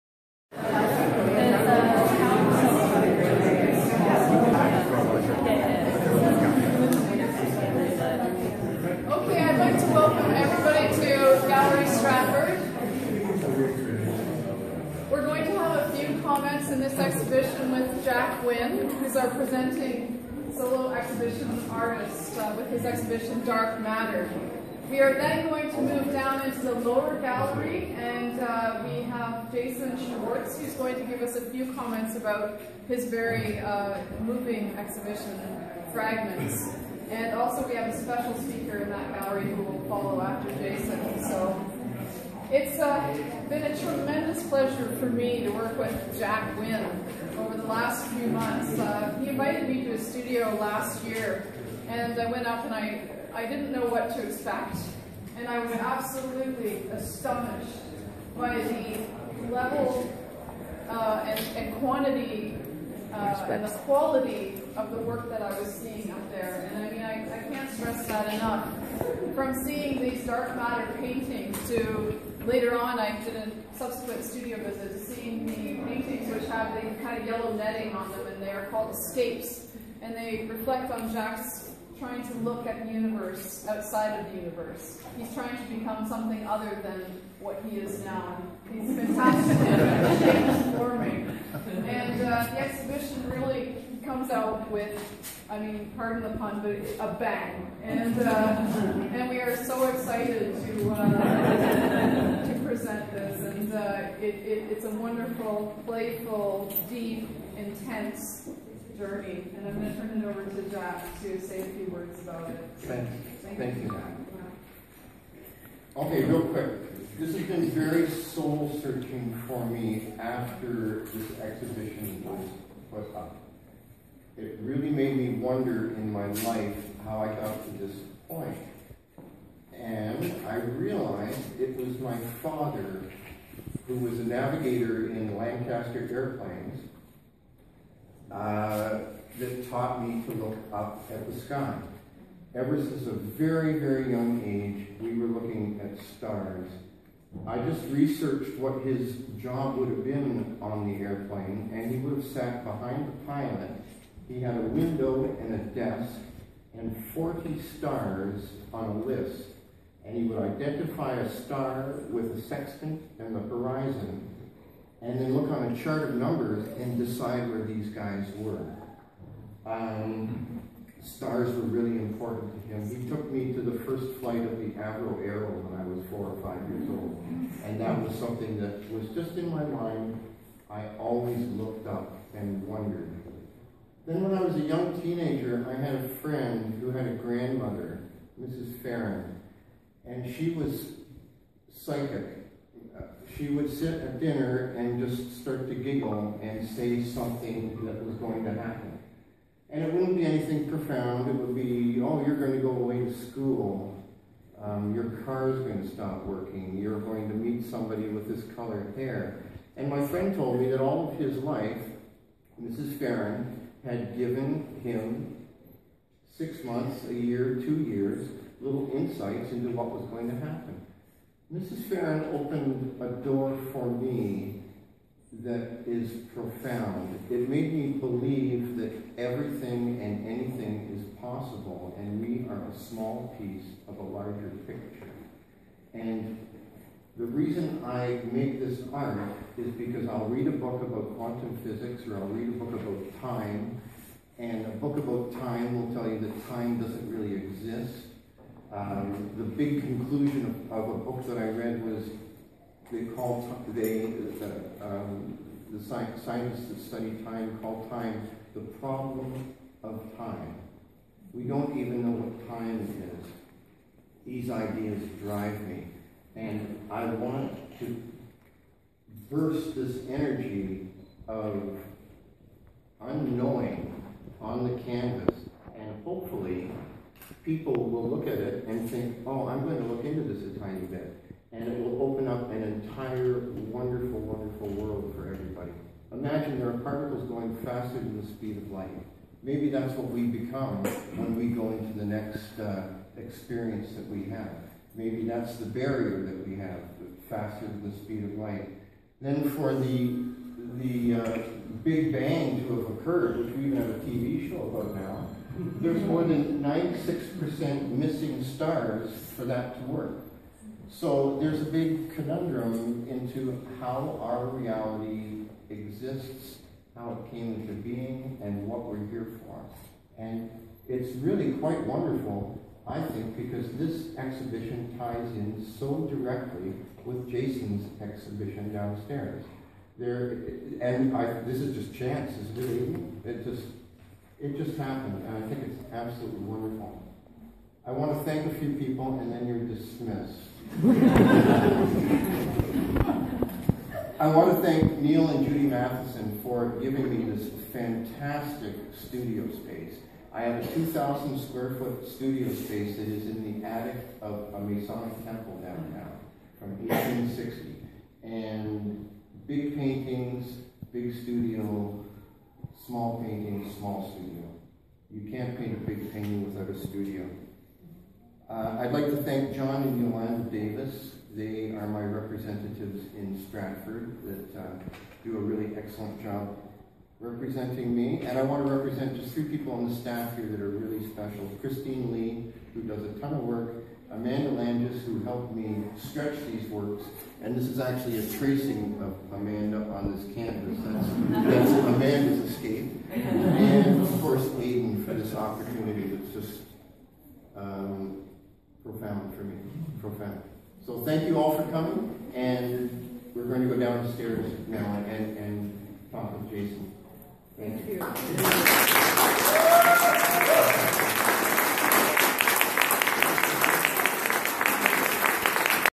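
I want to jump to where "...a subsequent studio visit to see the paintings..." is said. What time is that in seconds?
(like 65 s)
73 s.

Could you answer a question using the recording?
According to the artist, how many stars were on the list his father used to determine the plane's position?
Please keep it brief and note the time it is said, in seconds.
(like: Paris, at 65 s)
40, at 157 s.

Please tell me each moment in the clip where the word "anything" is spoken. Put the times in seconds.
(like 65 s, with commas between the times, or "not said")
200 s, 230 s.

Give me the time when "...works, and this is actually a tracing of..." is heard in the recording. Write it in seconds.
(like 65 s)
386 s.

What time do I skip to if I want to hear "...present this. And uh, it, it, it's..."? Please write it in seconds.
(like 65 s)
102 s.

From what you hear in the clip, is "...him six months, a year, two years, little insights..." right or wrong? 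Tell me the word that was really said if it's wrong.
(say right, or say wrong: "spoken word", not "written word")
right.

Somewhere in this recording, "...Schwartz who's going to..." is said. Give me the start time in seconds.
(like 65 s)
30 s.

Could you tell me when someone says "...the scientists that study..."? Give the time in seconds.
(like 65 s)
255 s.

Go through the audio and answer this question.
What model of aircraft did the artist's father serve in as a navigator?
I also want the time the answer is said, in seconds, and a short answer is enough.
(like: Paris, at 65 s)
Lancaster, at 135 s.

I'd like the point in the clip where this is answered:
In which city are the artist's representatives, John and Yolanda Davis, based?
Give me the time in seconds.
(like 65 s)
373 s.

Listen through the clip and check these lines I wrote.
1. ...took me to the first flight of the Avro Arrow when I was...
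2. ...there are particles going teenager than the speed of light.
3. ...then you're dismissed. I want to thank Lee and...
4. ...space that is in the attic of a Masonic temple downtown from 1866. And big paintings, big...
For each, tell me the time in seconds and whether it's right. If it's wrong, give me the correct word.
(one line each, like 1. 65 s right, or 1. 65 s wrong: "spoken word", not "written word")
1. 173 s right
2. 286 s wrong: "faster", not "teenager"
3. 339 s wrong: "Neil", not "Lee"
4. 352 s wrong: "1860", not "1866".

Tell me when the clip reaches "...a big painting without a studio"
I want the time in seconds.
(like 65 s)
365 s.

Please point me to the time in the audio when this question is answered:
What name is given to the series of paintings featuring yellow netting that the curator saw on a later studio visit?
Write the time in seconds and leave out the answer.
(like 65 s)
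78 s.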